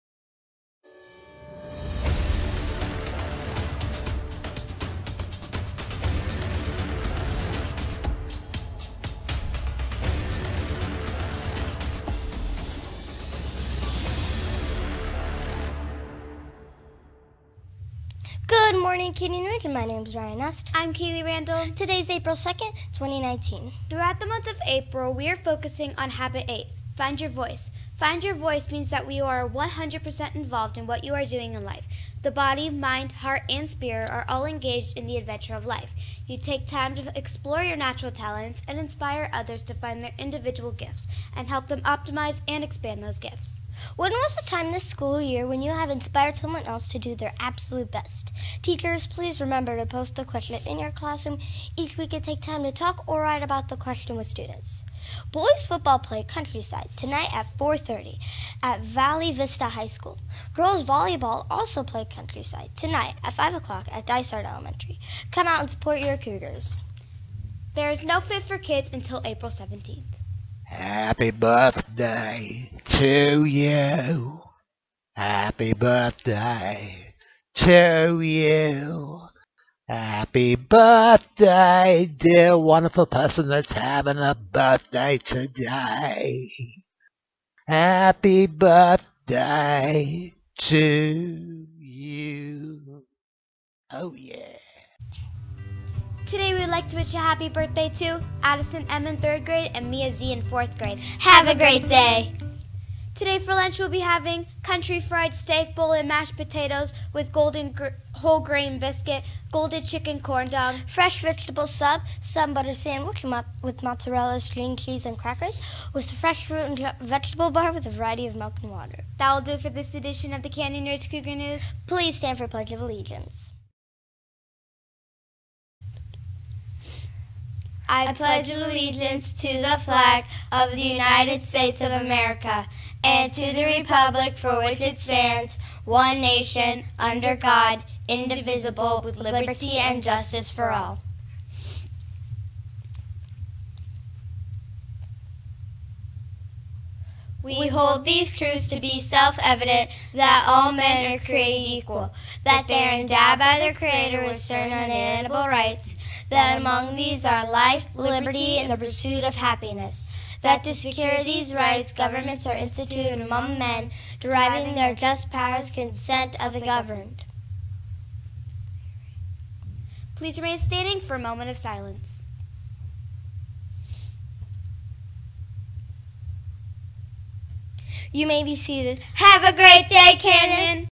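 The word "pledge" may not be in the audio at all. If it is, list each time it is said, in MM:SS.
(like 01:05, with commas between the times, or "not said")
02:02, 02:08.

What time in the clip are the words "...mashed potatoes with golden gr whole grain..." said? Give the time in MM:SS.
01:46.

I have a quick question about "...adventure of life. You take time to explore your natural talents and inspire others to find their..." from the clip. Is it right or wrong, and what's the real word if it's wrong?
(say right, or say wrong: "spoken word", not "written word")
right.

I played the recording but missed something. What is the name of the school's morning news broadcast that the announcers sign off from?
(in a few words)
Canyon Ridge Cougar News.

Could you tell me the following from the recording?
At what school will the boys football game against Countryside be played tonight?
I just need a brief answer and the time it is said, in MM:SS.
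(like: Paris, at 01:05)
Valley Vista High School, at 00:58.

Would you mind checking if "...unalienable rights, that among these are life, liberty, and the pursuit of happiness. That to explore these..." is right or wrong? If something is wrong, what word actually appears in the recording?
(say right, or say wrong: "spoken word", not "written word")
wrong: "secure", not "explore".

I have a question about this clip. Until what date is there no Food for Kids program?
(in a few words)
April 17th.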